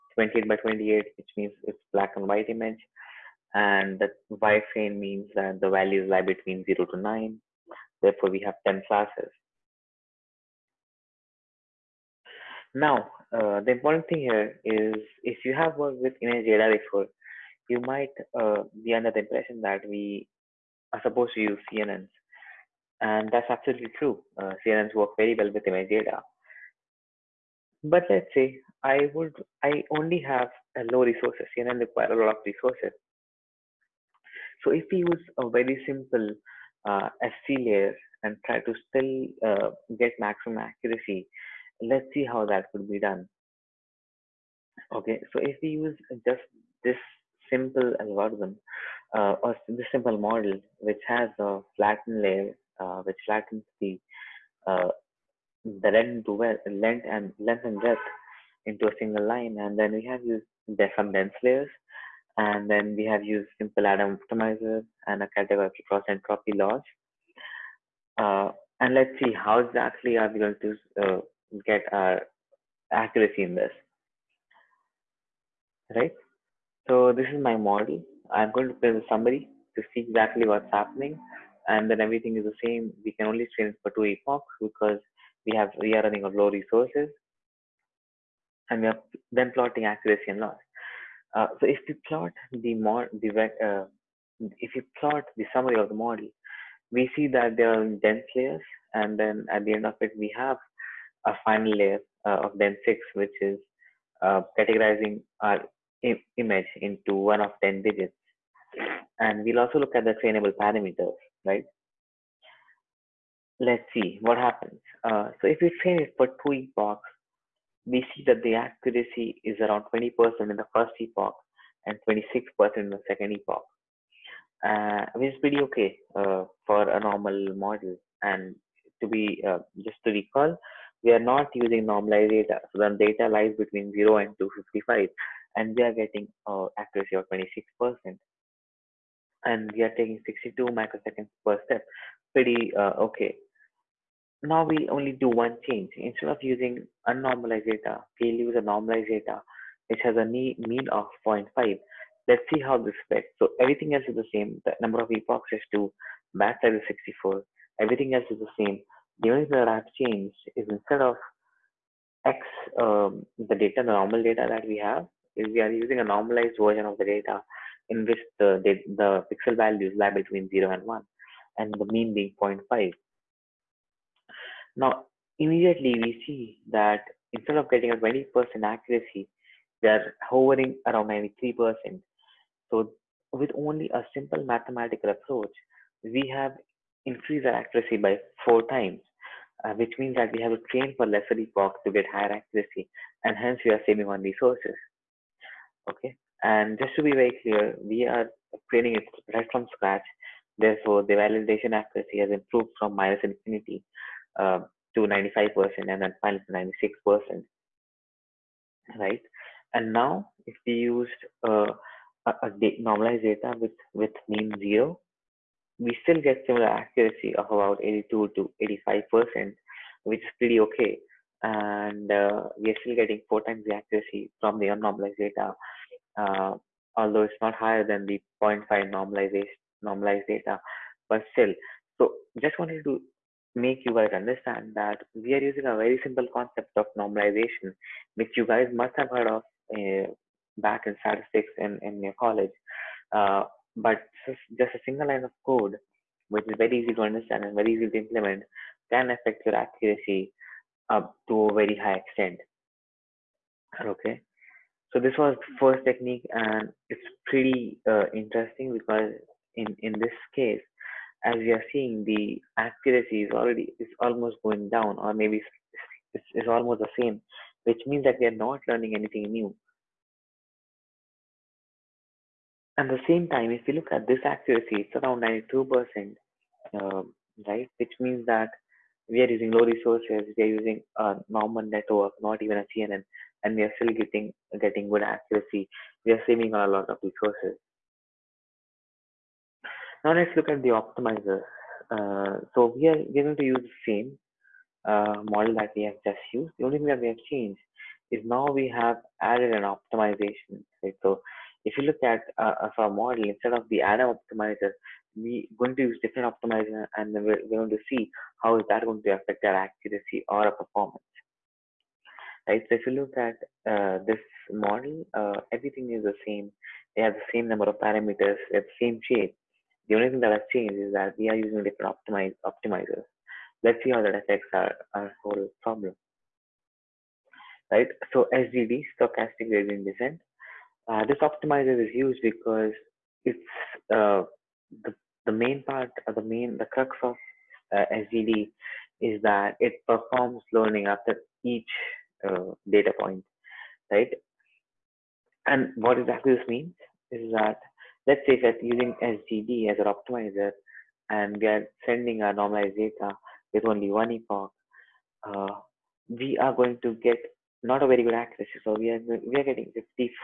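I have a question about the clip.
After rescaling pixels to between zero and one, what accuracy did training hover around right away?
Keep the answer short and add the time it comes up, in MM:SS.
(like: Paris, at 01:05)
93%, at 03:00.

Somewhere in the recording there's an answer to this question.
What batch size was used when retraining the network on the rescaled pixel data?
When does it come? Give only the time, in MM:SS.
02:36.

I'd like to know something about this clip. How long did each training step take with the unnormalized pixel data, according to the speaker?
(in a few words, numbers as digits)
62 microseconds.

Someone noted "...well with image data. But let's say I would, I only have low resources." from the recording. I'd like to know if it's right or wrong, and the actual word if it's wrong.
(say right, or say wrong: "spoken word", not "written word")
right.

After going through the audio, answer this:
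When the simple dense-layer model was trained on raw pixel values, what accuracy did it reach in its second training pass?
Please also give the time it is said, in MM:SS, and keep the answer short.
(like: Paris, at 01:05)
26%, at 02:02.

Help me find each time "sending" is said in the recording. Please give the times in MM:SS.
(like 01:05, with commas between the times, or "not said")
05:51.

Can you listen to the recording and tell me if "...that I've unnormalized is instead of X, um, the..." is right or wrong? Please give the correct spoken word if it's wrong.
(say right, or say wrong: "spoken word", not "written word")
wrong: "changed", not "unnormalized".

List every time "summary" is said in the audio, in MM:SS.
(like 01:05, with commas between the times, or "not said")
01:19, 01:35.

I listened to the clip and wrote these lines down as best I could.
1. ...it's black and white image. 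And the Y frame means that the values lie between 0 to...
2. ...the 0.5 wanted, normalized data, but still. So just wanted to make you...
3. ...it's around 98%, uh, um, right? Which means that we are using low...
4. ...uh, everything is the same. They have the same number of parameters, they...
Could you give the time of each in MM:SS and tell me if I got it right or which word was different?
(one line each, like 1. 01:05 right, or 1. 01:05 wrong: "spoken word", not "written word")
1. 00:01 right
2. 03:48 wrong: "normalized", not "wanted"
3. 04:34 wrong: "92", not "98"
4. 05:15 right.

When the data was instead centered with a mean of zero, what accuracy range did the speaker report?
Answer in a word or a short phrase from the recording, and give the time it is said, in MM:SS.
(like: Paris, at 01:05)
82 to 85%, at 03:37.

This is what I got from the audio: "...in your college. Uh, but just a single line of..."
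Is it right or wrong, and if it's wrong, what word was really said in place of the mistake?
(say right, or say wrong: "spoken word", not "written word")
right.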